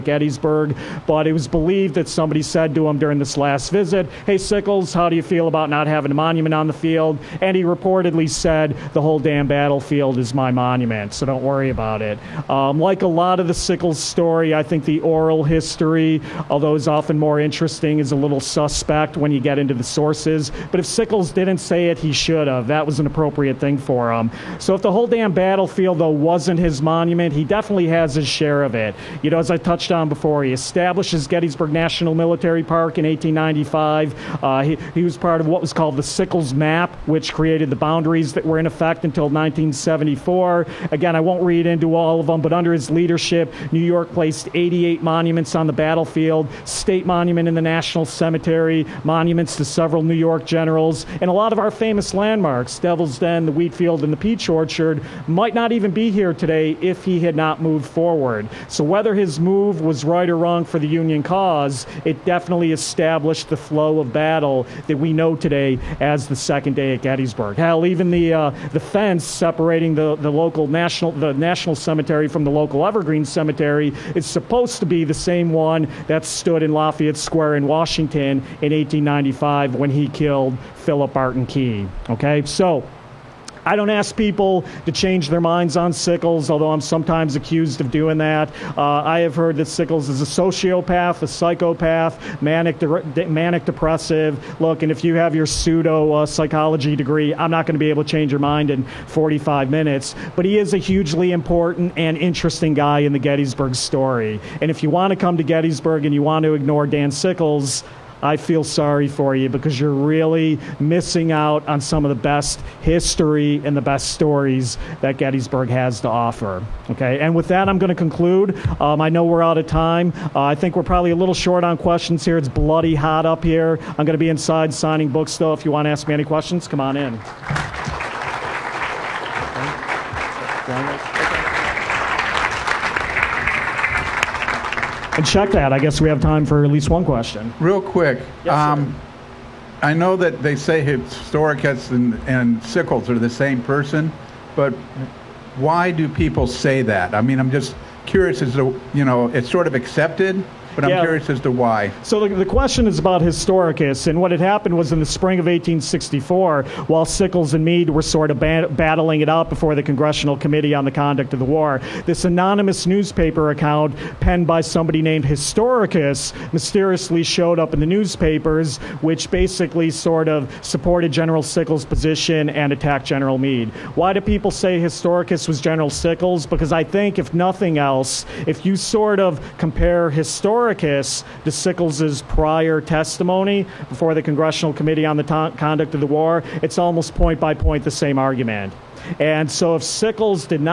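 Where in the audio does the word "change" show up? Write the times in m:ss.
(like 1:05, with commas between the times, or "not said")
1:24, 1:38.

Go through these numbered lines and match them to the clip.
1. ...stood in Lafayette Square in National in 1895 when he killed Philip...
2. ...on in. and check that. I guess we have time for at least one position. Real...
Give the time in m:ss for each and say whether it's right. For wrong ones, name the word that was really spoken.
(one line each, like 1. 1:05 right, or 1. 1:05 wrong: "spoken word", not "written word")
1. 1:16 wrong: "Washington", not "National"
2. 2:06 wrong: "question", not "position".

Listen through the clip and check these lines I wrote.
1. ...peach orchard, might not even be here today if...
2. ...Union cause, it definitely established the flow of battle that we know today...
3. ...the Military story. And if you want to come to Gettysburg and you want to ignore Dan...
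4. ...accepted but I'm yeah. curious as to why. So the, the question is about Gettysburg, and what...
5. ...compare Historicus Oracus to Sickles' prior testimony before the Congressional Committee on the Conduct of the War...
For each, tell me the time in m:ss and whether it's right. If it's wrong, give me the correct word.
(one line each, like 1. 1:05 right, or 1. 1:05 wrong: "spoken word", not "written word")
1. 0:54 right
2. 1:00 right
3. 1:43 wrong: "Gettysburg", not "Military"
4. 2:29 wrong: "Historicus", not "Gettysburg"
5. 2:59 right.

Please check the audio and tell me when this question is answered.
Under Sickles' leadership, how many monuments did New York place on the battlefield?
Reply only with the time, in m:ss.
0:44.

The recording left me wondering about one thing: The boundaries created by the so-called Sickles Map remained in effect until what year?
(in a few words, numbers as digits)
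1974.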